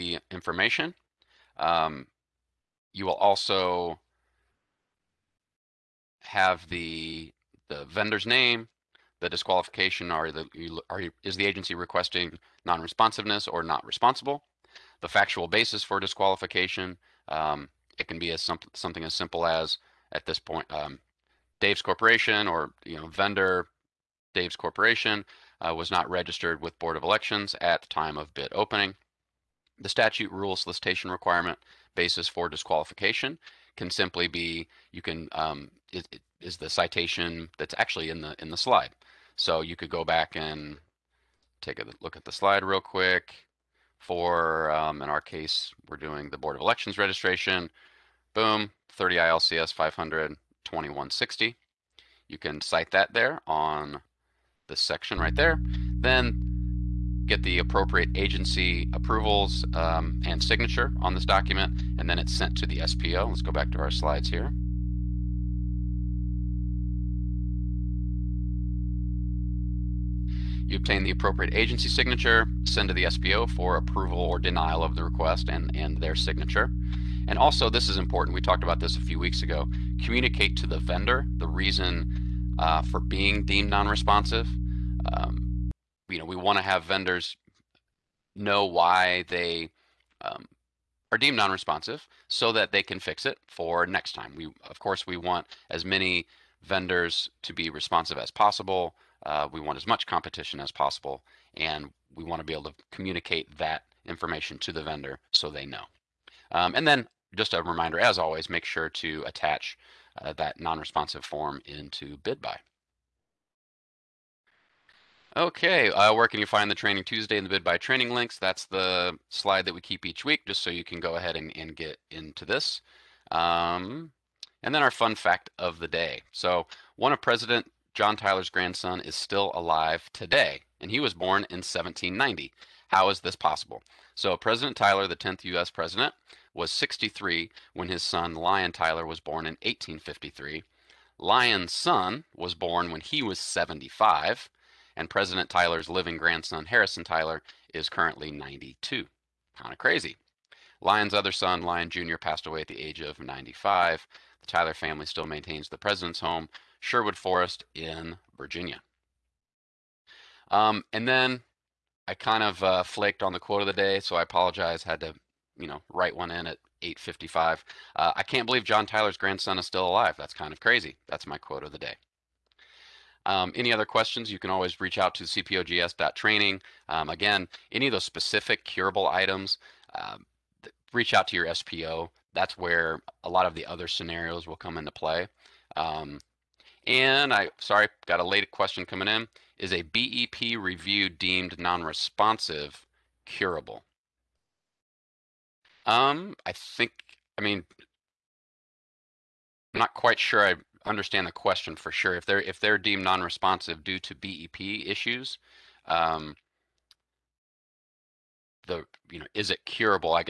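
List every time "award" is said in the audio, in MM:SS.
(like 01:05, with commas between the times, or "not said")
not said.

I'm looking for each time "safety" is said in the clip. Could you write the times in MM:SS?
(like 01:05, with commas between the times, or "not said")
not said.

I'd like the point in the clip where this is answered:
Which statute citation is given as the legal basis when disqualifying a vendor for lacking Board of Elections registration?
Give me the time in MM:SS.
00:48.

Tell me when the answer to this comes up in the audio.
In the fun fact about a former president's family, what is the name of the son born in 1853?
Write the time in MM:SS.
02:18.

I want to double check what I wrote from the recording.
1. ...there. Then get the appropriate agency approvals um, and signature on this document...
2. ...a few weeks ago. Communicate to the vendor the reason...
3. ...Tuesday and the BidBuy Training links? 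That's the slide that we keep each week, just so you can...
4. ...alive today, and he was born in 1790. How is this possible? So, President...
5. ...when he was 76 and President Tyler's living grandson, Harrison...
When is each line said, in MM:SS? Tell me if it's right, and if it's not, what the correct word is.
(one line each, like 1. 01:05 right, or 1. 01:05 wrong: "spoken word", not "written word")
1. 00:55 right
2. 01:18 right
3. 01:57 right
4. 02:09 right
5. 02:22 wrong: "75", not "76".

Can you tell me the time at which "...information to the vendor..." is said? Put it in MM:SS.
01:44.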